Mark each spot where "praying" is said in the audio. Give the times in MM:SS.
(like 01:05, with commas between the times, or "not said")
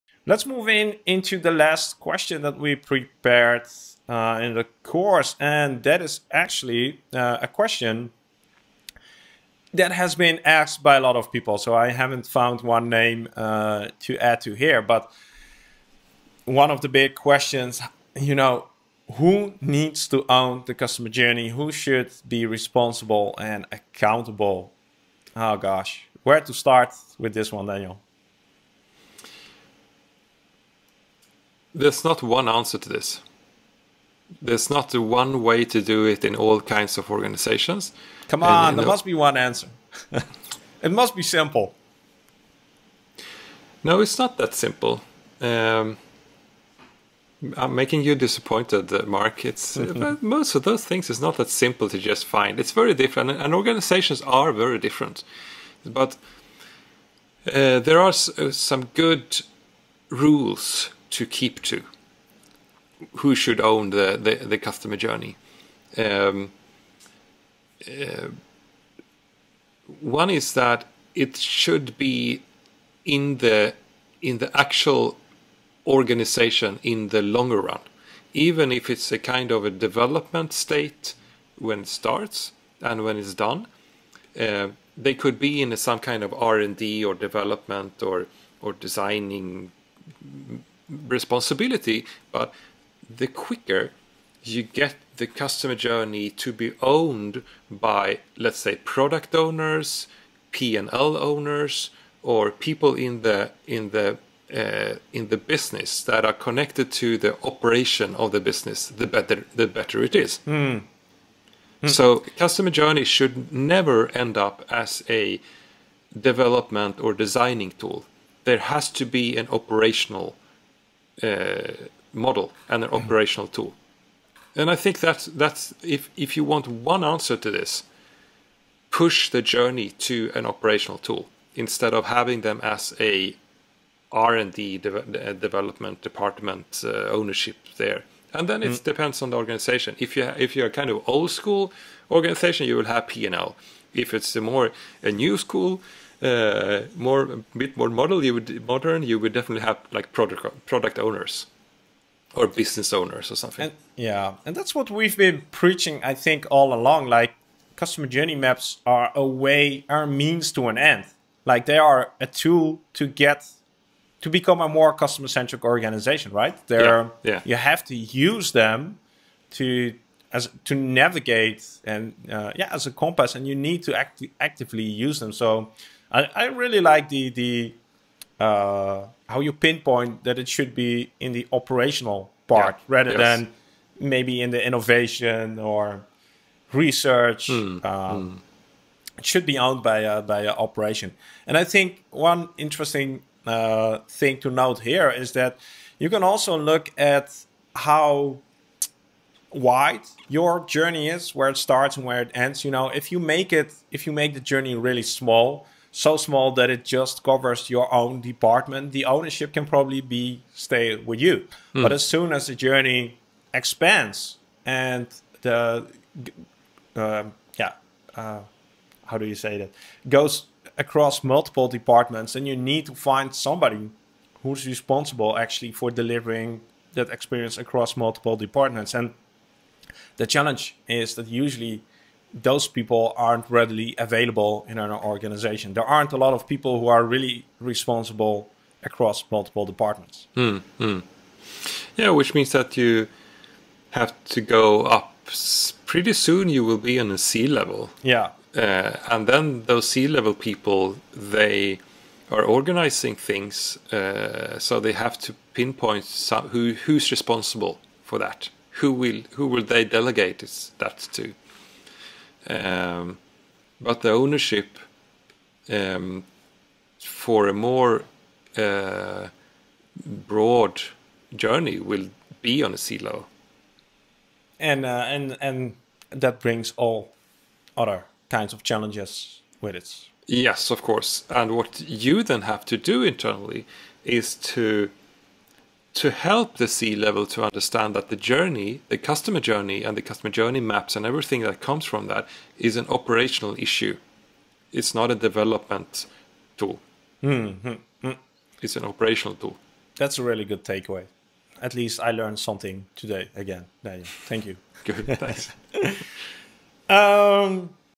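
not said.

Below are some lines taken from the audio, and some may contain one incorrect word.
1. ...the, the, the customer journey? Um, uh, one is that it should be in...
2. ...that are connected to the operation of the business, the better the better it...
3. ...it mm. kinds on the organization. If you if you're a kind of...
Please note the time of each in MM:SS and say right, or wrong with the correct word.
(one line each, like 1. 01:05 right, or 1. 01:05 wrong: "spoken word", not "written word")
1. 01:03 right
2. 01:46 right
3. 02:18 wrong: "depends", not "kinds".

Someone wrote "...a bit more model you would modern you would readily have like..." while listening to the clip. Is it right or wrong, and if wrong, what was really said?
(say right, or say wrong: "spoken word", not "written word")
wrong: "definitely", not "readily".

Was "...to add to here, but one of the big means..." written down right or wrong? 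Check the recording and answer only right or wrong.
wrong.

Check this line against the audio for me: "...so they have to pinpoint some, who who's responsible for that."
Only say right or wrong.
right.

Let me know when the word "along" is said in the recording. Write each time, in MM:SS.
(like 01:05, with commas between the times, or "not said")
02:36.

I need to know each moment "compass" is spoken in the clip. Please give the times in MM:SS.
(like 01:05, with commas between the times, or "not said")
02:52.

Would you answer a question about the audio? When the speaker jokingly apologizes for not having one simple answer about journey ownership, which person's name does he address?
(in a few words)
Mark.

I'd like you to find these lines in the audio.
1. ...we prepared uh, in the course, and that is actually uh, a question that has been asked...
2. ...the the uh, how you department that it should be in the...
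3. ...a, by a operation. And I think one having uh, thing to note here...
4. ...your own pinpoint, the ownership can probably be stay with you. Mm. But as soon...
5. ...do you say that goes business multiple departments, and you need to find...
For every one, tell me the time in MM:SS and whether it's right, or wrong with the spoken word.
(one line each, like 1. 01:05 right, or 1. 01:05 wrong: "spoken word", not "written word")
1. 00:02 right
2. 02:57 wrong: "pinpoint", not "department"
3. 03:09 wrong: "interesting", not "having"
4. 03:27 wrong: "department", not "pinpoint"
5. 03:39 wrong: "across", not "business".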